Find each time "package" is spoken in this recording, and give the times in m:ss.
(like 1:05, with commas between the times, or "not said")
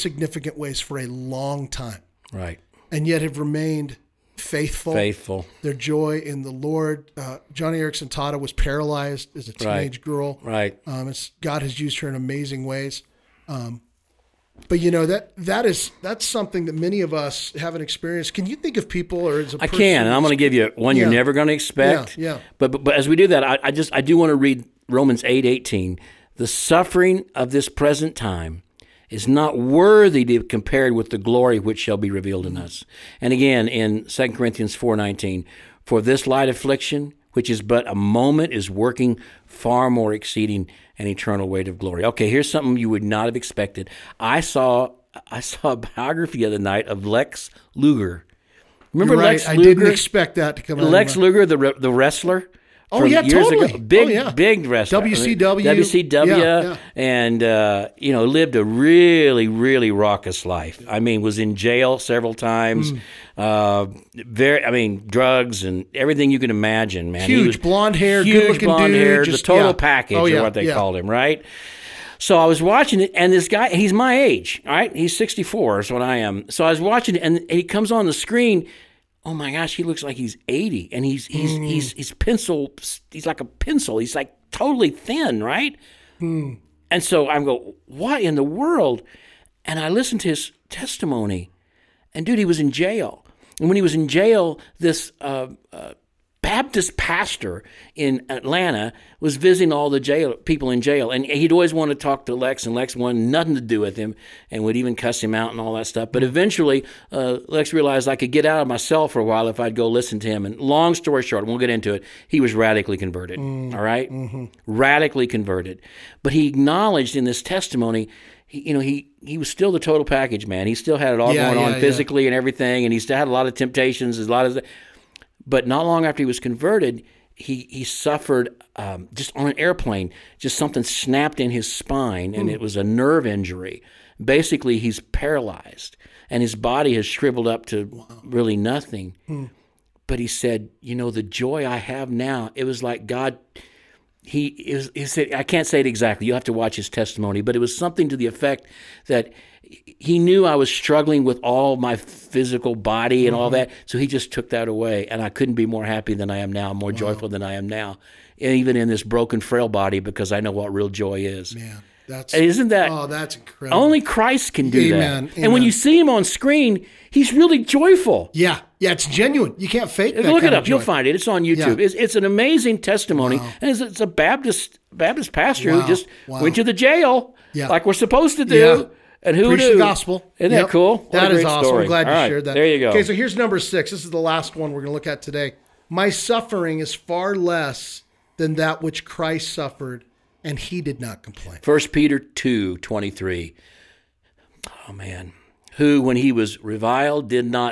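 1:09, 2:00.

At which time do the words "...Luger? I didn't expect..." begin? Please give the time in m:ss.
0:49.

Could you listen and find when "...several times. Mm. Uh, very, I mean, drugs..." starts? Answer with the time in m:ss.
1:01.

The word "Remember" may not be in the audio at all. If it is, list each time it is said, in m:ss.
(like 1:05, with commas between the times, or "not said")
0:48.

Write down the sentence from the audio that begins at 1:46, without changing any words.
But eventually, uh, Lex realized I could get out of myself for a while if I'd go listen to him.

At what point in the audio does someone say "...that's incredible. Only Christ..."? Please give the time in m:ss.
2:43.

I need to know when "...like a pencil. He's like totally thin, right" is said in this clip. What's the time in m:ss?
1:23.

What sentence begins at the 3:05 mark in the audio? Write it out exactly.
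My suffering is far less than that which Christ suffered and he did not complain.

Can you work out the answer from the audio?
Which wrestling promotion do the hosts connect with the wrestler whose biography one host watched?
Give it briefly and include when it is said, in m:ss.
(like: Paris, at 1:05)
WCW, at 0:55.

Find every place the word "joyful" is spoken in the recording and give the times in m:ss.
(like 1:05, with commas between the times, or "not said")
2:36, 2:47.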